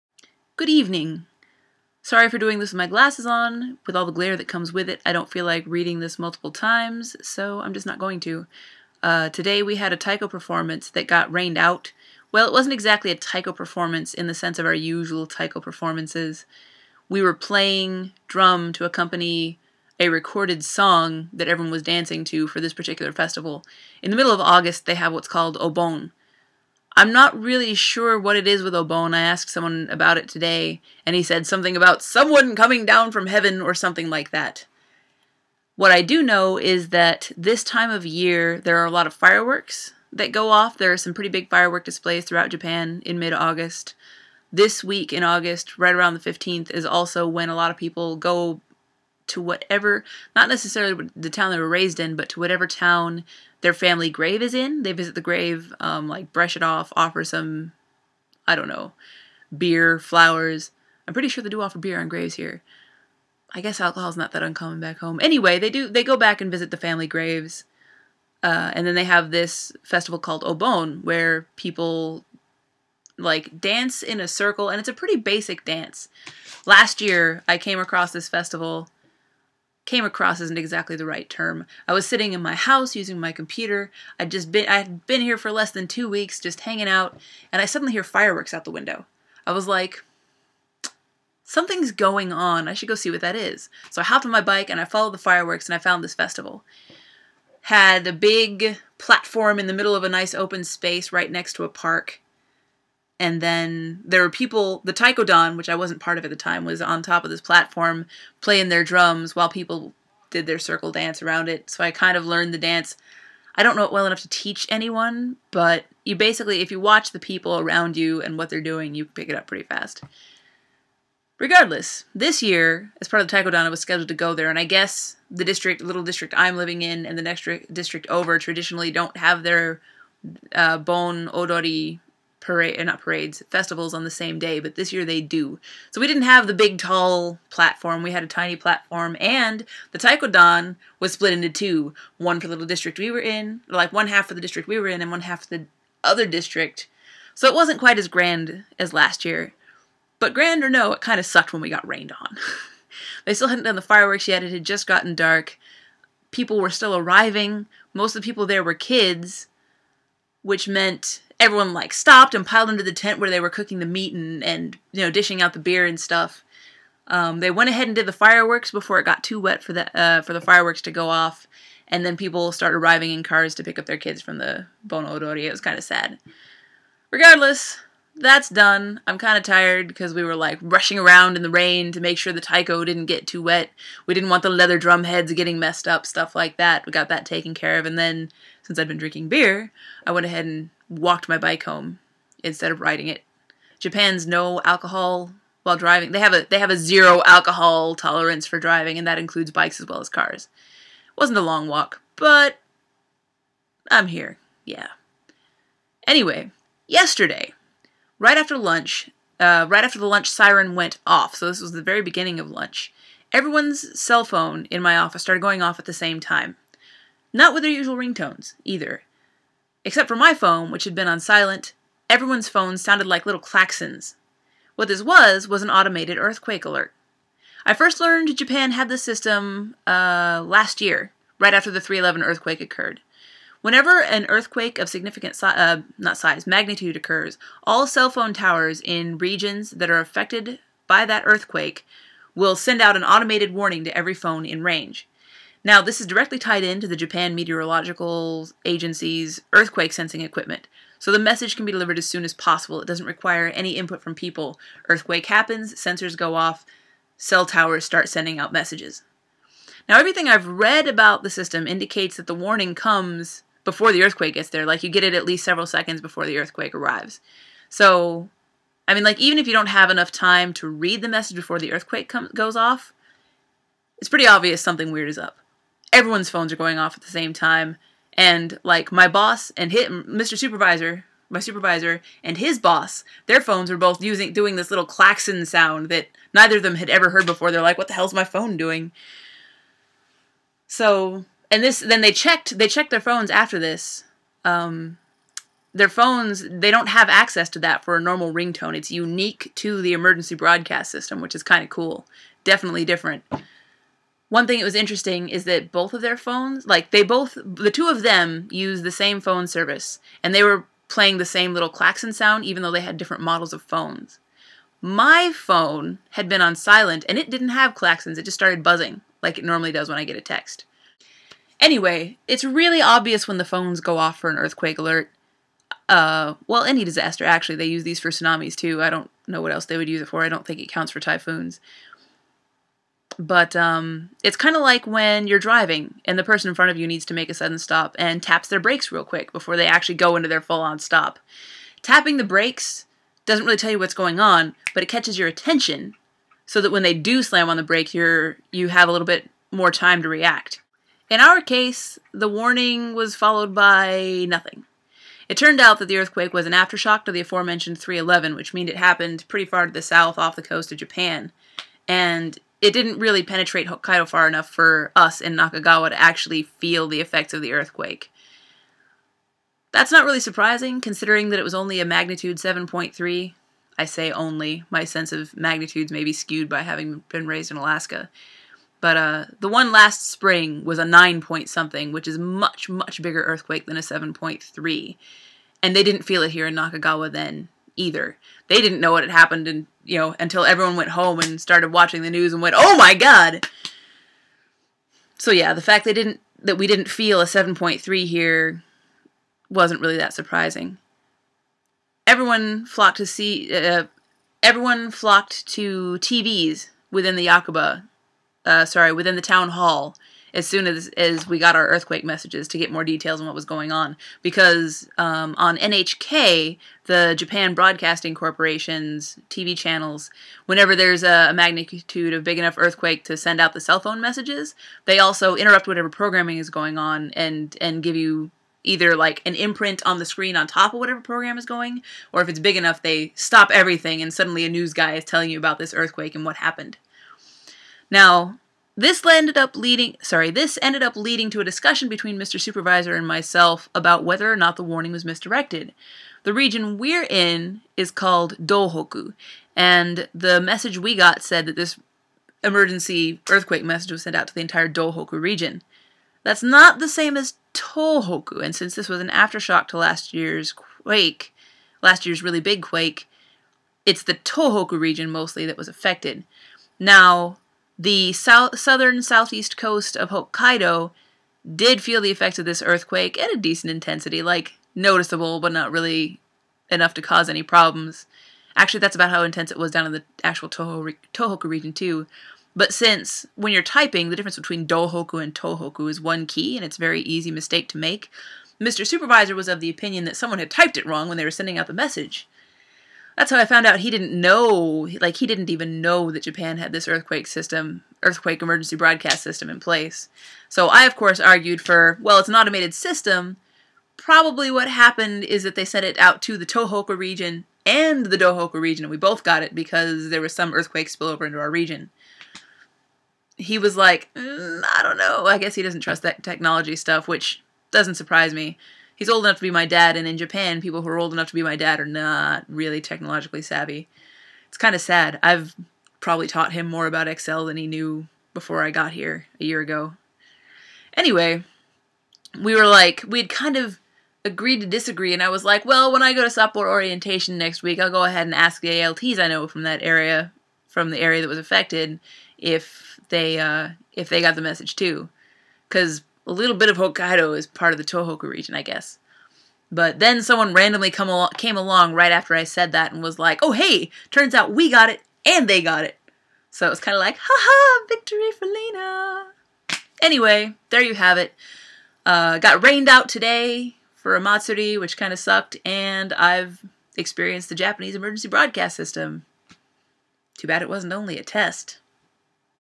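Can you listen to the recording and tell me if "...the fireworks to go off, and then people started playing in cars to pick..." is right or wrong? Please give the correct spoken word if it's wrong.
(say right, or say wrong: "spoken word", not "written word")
wrong: "arriving", not "playing".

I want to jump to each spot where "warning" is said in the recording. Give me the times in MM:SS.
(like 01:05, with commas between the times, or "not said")
04:03, 04:22, 05:52, 07:24.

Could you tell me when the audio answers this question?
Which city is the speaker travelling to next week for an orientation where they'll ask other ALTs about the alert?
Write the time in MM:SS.
08:56.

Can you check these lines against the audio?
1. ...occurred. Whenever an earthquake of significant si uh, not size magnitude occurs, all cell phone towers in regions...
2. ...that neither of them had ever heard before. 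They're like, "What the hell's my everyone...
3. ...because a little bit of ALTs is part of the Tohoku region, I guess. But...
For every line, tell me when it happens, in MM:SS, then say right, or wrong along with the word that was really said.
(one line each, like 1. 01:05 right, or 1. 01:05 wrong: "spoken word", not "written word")
1. 03:52 right
2. 04:45 wrong: "phone", not "everyone"
3. 09:05 wrong: "Hokkaido", not "ALTs".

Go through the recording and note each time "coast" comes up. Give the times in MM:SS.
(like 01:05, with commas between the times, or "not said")
06:00, 07:49.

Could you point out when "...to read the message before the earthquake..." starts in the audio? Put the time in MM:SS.
04:30.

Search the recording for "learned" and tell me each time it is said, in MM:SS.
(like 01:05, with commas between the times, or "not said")
01:52, 03:47.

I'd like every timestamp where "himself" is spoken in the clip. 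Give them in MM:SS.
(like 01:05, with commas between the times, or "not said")
not said.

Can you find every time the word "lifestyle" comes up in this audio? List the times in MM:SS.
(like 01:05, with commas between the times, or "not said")
not said.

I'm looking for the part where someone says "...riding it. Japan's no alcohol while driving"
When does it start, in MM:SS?
03:12.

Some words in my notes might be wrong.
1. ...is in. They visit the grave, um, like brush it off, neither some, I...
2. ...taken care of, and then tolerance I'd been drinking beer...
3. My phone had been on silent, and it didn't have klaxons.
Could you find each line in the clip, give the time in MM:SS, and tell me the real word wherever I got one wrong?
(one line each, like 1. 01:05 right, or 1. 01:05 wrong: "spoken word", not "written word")
1. 00:54 wrong: "offer", not "neither"
2. 03:07 wrong: "since", not "tolerance"
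3. 05:14 right.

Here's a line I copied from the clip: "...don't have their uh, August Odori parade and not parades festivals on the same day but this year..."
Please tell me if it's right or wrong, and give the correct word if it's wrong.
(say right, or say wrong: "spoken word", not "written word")
wrong: "Bon", not "August".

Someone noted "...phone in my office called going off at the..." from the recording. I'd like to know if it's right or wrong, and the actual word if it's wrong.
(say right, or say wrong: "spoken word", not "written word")
wrong: "started", not "called".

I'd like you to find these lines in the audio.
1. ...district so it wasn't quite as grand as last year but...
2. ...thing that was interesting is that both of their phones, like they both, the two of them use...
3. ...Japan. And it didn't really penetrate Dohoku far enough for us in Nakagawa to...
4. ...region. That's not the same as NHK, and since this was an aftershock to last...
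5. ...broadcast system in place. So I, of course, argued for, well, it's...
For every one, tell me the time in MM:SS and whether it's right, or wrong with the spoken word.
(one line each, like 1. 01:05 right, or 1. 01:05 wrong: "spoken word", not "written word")
1. 02:26 right
2. 05:04 right
3. 06:00 wrong: "Hokkaido", not "Dohoku"
4. 07:35 wrong: "Tohoku", not "NHK"
5. 08:18 right.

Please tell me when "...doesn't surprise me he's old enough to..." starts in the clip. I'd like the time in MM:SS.
08:37.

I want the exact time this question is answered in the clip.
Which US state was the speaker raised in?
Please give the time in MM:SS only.
06:17.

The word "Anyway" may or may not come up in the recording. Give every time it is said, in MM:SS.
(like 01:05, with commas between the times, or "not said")
01:05, 03:26, 05:21, 08:50, 09:20.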